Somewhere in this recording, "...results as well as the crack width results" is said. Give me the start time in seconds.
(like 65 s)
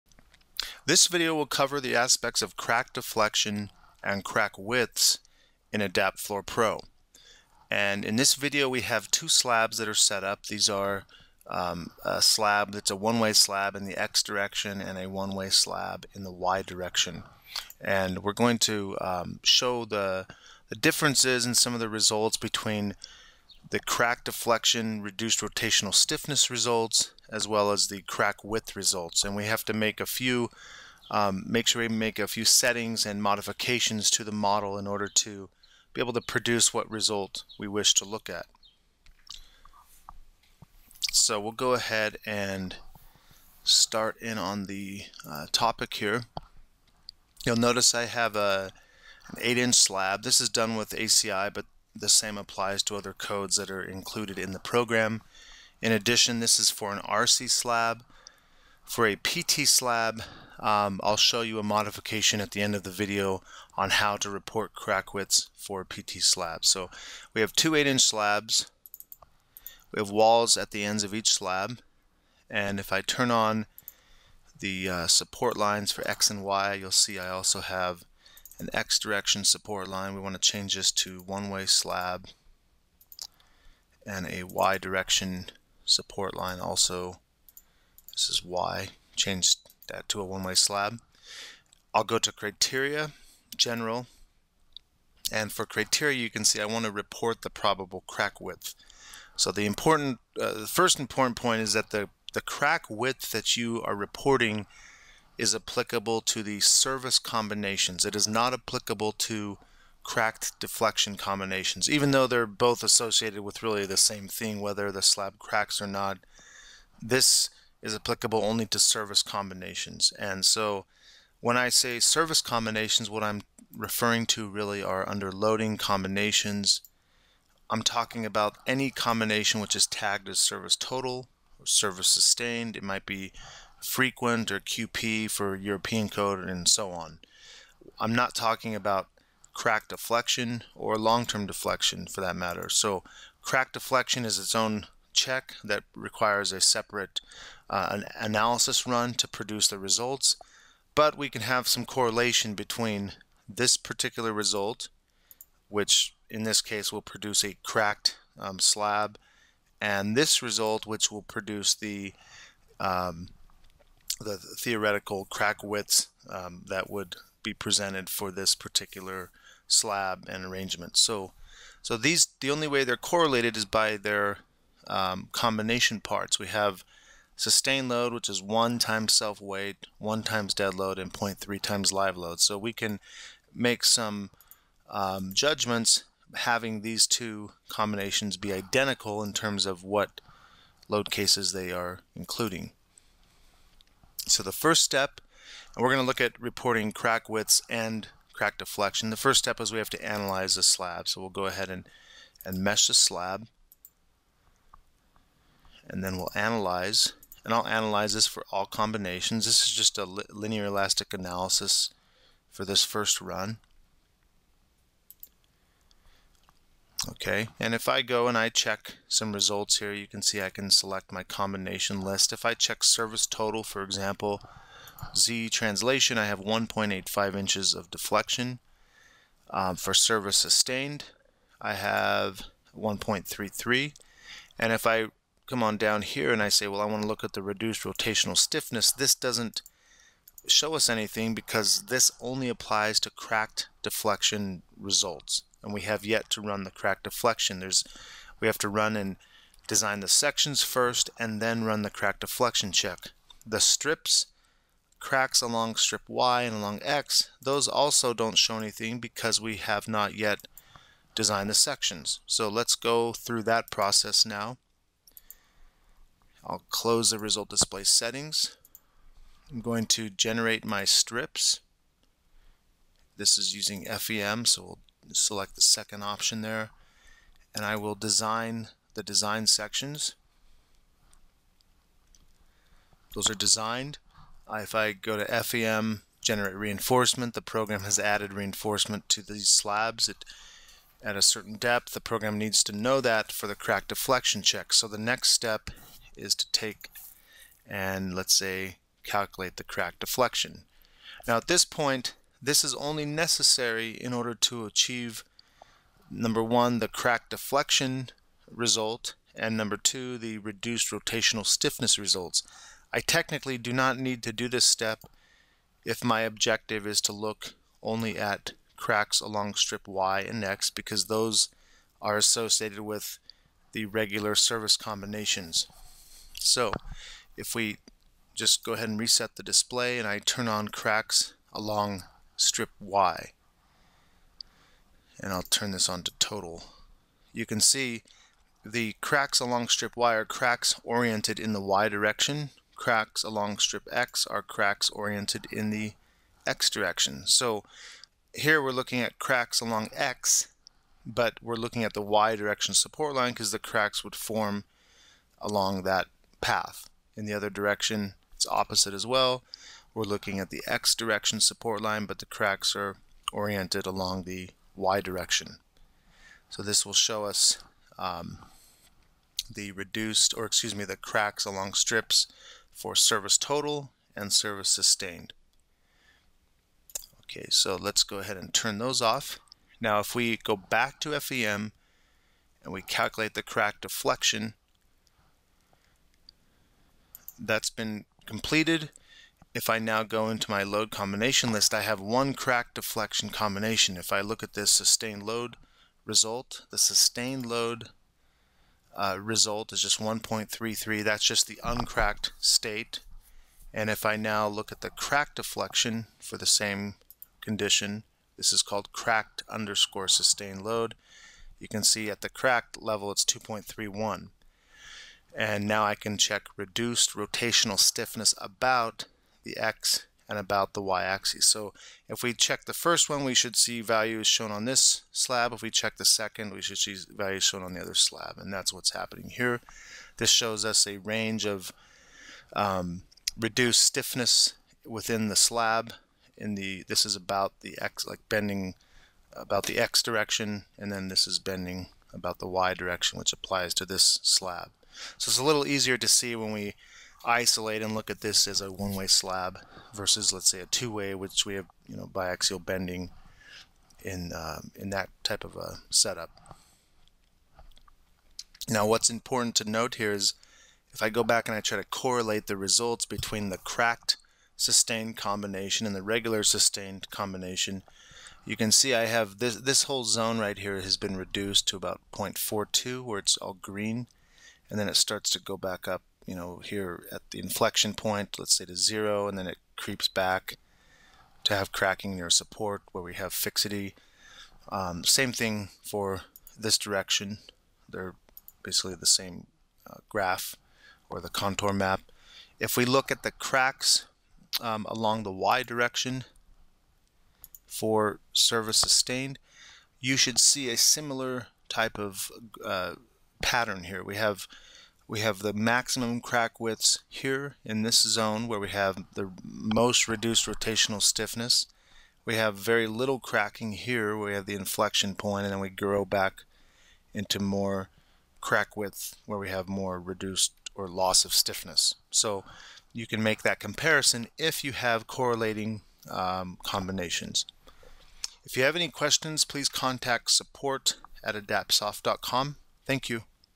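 26 s.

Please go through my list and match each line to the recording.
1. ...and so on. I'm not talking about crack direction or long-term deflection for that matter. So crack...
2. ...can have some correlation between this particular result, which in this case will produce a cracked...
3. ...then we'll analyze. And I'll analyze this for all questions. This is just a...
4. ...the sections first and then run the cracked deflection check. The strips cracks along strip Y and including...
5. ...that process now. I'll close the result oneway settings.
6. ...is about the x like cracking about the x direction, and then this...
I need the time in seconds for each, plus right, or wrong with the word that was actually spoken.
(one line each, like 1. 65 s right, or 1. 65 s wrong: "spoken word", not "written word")
1. 136 s wrong: "deflection", not "direction"
2. 151 s right
3. 206 s wrong: "combinations", not "questions"
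4. 250 s wrong: "along", not "including"
5. 263 s wrong: "display", not "oneway"
6. 437 s wrong: "bending", not "cracking".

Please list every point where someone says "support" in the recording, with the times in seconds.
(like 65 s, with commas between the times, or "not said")
75 s, 79 s, 85 s, 352 s, 361 s, 482 s, 530 s.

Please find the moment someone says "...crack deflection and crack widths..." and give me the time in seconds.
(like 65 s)
2 s.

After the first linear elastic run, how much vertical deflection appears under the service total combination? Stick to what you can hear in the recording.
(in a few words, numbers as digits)
1.85 inches.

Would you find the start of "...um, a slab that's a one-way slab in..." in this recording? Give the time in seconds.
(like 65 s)
11 s.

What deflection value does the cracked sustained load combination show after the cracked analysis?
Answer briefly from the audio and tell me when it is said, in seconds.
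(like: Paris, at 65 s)
2.31, at 413 s.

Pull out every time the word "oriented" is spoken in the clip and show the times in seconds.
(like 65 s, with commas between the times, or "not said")
340 s, 344 s, 363 s.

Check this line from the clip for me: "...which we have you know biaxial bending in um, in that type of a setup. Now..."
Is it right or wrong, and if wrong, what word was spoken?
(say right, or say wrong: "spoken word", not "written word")
right.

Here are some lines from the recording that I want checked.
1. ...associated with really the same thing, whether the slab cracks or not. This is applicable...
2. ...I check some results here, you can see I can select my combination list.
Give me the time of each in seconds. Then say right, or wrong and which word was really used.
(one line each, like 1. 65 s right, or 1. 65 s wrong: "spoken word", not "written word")
1. 112 s right
2. 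218 s right.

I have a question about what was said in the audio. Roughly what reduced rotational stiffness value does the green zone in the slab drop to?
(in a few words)
0.42.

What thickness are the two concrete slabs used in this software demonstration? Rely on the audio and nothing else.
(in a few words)
8 inch.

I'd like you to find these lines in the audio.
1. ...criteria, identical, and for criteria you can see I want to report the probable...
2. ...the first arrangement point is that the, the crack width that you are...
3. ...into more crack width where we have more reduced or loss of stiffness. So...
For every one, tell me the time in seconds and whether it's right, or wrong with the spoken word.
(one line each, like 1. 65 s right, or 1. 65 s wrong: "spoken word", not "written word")
1. 92 s wrong: "general", not "identical"
2. 100 s wrong: "important", not "arrangement"
3. 517 s right.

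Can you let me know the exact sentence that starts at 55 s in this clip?
In addition, this is for an RC slab.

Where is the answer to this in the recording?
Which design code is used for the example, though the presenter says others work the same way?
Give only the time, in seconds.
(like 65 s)
50 s.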